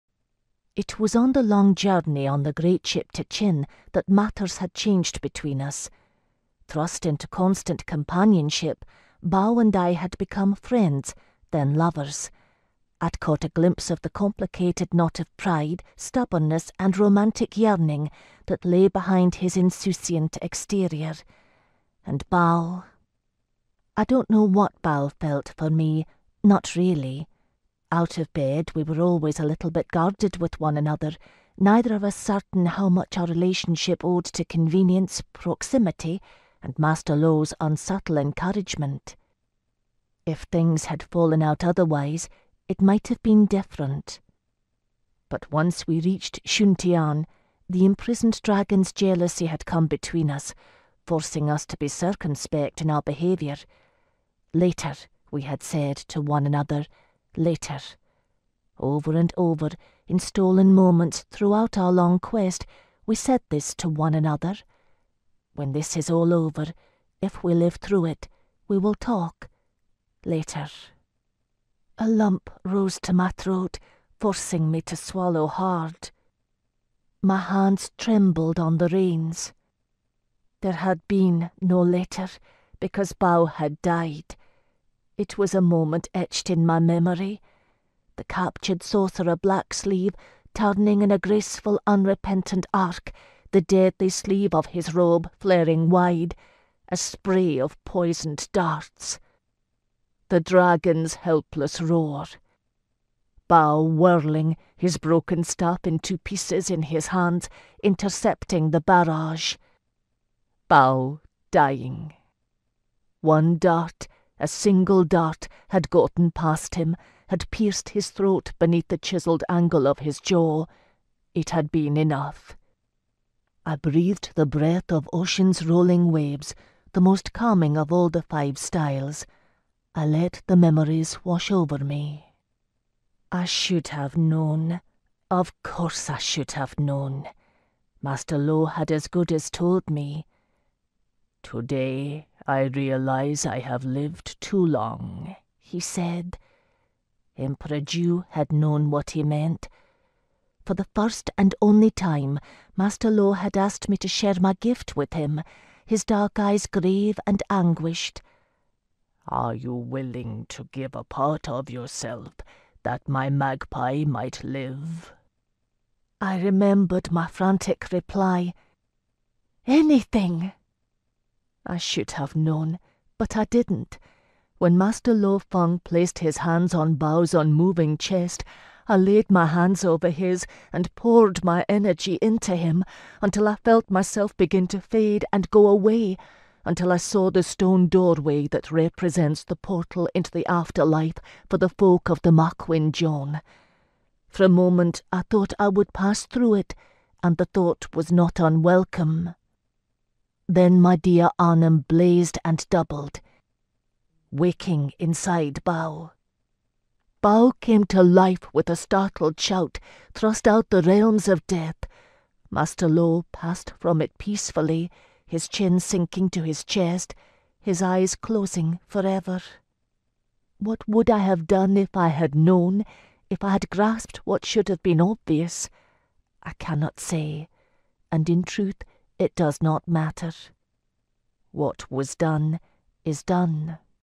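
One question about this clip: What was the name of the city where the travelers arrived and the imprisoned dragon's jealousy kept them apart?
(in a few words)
Shuntian.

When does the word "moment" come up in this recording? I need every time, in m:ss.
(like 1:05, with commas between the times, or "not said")
1:00, 1:25, 3:14.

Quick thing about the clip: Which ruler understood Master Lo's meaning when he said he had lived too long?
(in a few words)
Emperor Zhu.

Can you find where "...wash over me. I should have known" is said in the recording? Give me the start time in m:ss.
2:11.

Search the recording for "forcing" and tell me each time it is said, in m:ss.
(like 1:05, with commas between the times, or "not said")
0:51, 1:14.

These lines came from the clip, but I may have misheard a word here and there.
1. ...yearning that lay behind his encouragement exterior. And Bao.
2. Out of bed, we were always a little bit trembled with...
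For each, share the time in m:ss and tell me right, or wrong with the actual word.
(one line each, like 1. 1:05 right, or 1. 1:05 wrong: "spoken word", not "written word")
1. 0:17 wrong: "insouciant", not "encouragement"
2. 0:27 wrong: "guarded", not "trembled".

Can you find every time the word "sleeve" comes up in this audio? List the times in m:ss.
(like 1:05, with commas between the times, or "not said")
1:29, 1:34.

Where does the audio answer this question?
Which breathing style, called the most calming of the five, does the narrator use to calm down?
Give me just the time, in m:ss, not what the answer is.
2:05.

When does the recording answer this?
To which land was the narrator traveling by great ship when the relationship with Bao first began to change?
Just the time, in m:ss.
0:03.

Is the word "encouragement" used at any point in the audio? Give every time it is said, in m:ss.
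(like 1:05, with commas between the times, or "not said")
0:38.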